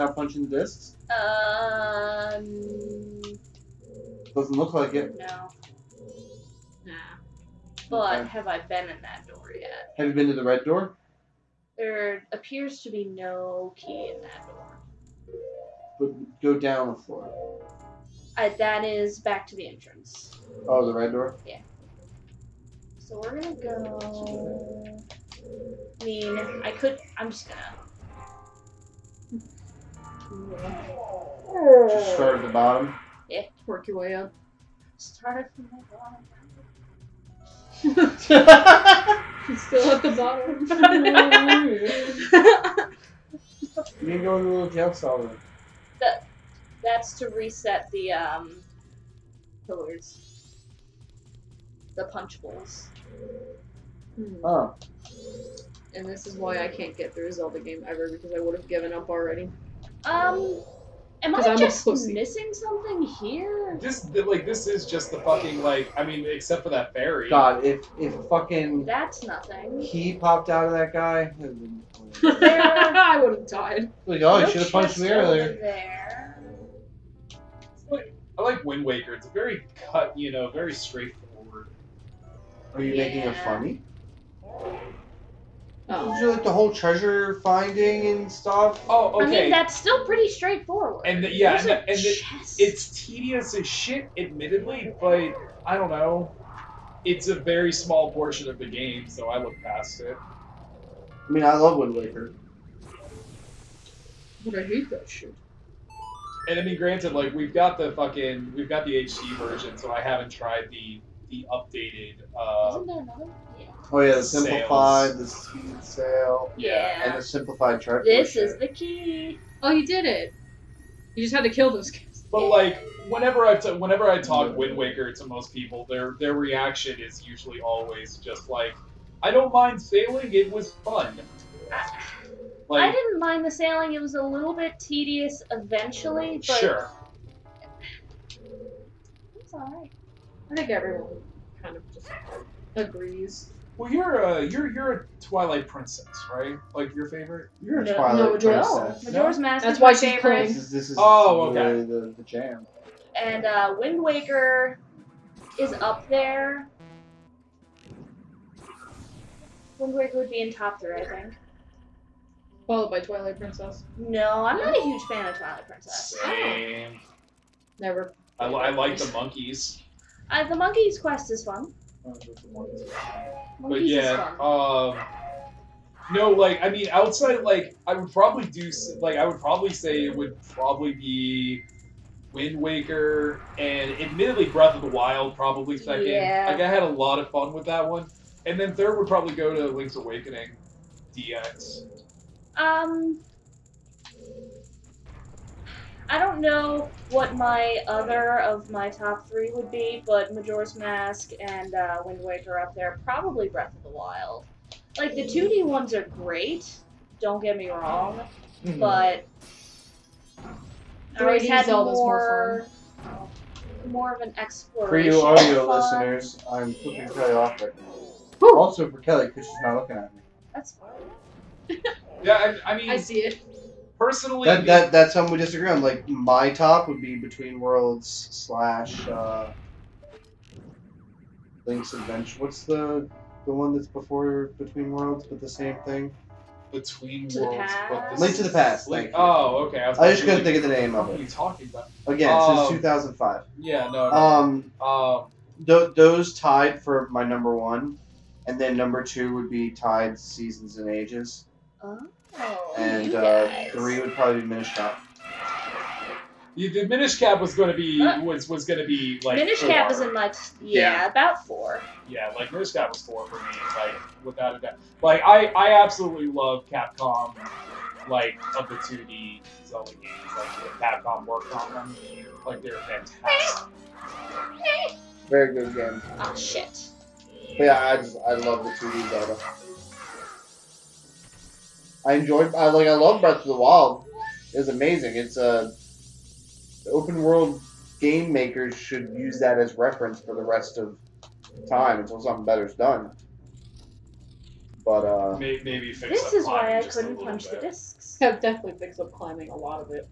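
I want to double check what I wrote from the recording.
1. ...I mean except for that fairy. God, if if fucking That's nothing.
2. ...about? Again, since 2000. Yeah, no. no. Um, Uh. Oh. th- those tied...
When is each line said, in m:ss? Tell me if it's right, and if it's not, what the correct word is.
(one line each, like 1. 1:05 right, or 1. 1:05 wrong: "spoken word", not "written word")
1. 1:05 right
2. 4:01 wrong: "2005", not "2000".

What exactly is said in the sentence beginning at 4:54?
But uh, maybe, maybe This is why I couldn't punch bit.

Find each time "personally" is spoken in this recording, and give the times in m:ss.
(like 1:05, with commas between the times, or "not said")
3:43.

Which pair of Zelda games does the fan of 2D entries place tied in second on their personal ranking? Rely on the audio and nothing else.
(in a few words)
Seasons and Ages.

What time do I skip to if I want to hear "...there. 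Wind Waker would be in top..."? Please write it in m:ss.
2:36.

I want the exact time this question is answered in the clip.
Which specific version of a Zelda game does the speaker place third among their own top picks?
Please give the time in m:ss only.
3:09.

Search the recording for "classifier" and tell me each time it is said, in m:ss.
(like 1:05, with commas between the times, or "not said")
not said.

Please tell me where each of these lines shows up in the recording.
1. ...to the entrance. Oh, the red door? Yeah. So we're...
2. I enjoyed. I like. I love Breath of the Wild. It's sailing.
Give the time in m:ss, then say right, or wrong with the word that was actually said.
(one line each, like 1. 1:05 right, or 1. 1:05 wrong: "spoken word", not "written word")
1. 0:19 right
2. 4:42 wrong: "amazing", not "sailing".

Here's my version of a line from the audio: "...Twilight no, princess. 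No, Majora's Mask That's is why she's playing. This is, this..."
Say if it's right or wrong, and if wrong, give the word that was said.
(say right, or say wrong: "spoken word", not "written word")
right.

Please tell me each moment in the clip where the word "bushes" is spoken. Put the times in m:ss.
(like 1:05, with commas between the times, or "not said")
not said.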